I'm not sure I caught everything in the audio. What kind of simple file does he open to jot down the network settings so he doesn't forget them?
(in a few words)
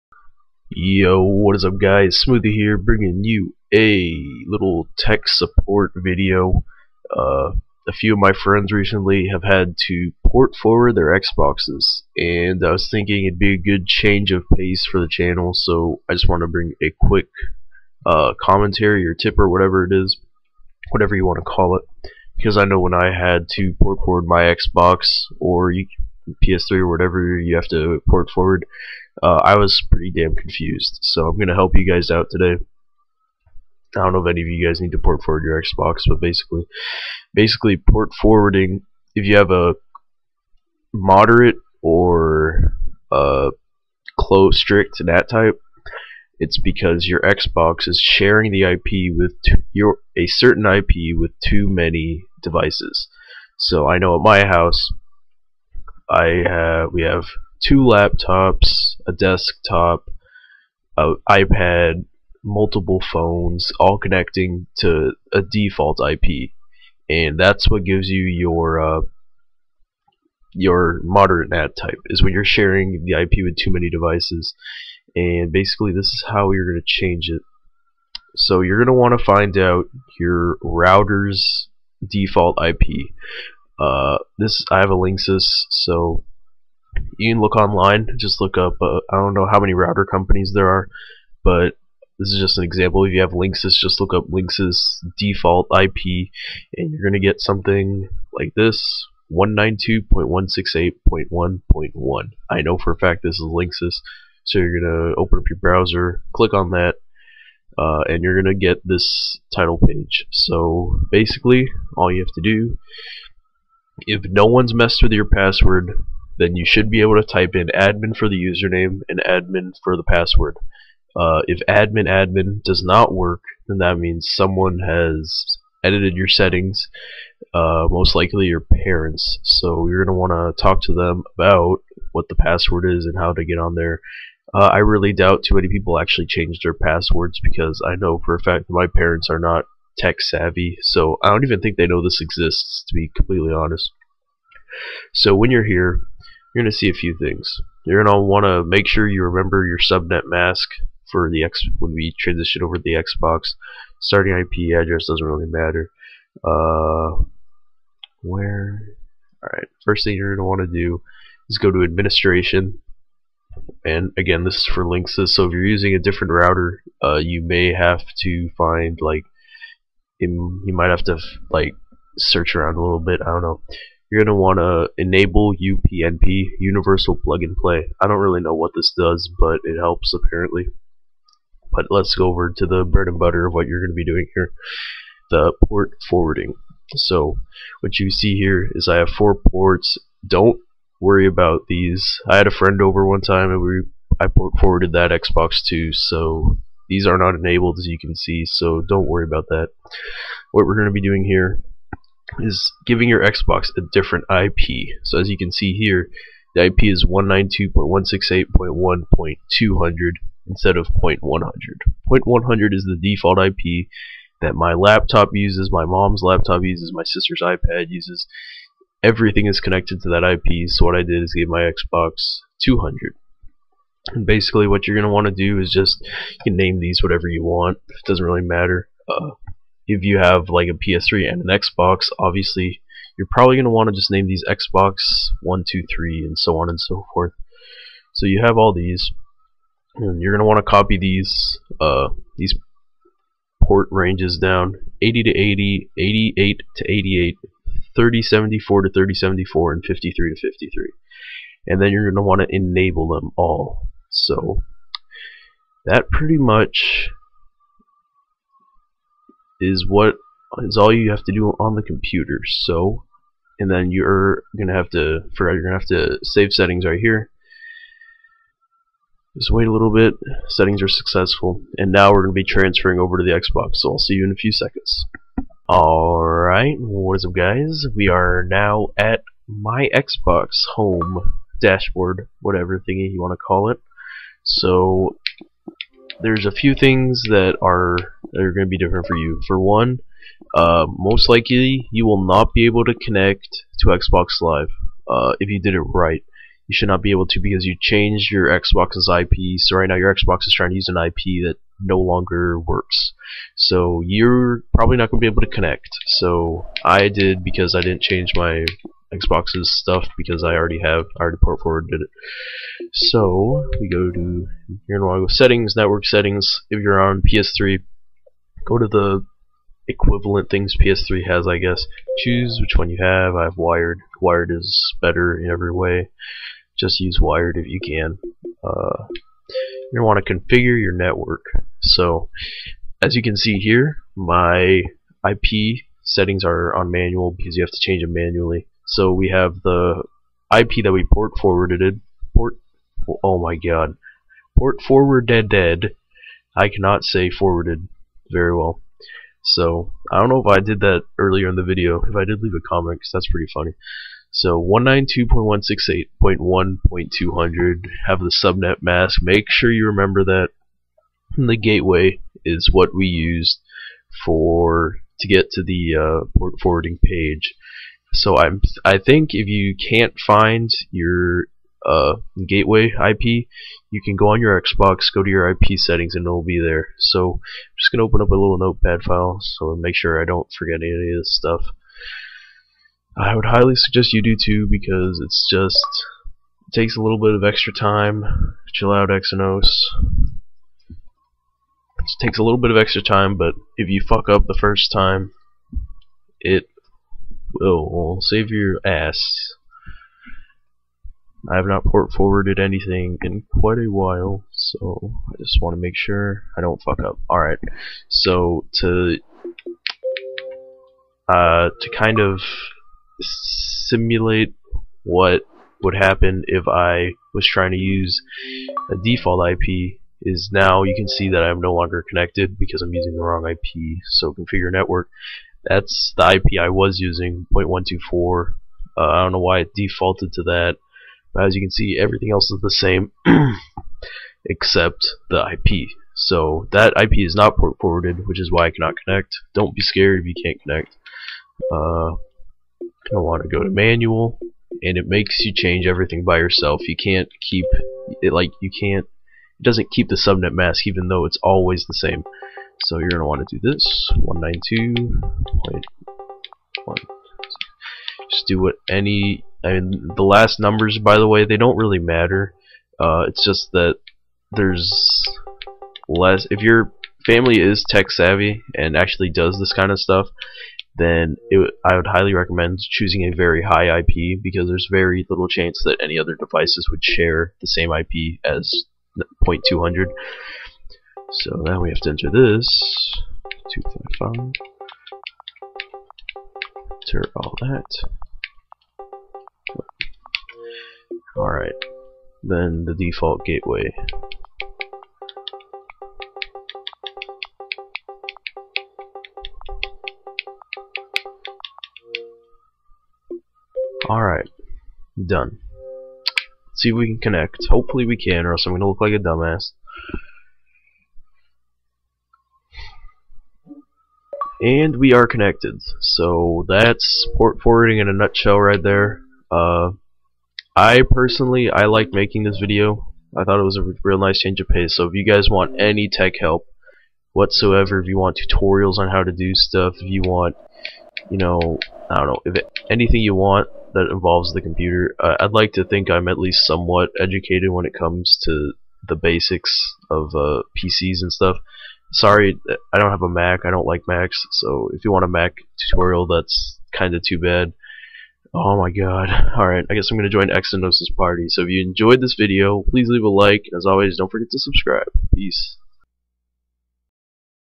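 notepad file.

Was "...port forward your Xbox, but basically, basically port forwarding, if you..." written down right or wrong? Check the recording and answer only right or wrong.
right.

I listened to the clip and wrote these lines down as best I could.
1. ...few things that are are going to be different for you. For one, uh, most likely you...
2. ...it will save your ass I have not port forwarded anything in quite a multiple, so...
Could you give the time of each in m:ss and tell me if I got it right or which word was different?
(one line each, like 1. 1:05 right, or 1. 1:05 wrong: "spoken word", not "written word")
1. 4:46 right
2. 6:36 wrong: "while", not "multiple".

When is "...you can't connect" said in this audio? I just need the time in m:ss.
7:20.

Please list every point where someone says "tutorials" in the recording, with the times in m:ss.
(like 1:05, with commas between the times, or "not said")
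8:48, 9:05.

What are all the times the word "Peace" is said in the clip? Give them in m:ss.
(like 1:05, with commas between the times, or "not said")
9:15.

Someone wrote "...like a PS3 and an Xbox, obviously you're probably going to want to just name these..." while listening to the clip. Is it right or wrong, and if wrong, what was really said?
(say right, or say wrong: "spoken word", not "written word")
right.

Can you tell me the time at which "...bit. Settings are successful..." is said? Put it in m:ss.
4:29.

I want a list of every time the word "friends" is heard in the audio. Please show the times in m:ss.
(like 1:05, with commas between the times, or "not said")
0:08, 3:12.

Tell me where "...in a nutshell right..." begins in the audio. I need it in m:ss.
8:37.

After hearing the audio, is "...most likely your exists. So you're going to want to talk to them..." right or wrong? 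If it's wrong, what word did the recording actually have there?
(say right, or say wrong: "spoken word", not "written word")
wrong: "parents", not "exists".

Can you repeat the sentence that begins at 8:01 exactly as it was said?
So now we have to enter this.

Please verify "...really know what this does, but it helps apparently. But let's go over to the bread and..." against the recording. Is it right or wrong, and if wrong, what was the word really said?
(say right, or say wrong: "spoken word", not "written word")
right.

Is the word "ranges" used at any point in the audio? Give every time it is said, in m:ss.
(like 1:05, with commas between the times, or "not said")
4:03.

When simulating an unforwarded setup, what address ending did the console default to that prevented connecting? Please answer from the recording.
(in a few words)
0.124.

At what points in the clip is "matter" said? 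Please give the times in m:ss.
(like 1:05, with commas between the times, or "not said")
2:35, 3:48, 7:41.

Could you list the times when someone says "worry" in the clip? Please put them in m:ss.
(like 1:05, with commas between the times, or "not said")
3:10, 3:19.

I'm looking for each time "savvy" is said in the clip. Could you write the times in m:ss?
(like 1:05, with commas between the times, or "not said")
2:20, 7:48.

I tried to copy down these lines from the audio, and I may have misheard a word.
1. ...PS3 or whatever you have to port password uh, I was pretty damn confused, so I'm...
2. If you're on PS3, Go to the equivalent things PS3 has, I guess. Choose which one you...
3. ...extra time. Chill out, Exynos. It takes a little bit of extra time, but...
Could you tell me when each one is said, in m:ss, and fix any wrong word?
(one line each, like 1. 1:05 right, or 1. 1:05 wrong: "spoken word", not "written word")
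1. 0:26 wrong: "forward", not "password"
2. 5:16 right
3. 6:27 right.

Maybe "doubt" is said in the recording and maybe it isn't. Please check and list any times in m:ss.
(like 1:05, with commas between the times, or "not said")
2:15.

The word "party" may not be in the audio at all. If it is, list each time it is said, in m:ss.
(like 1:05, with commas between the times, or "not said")
9:11.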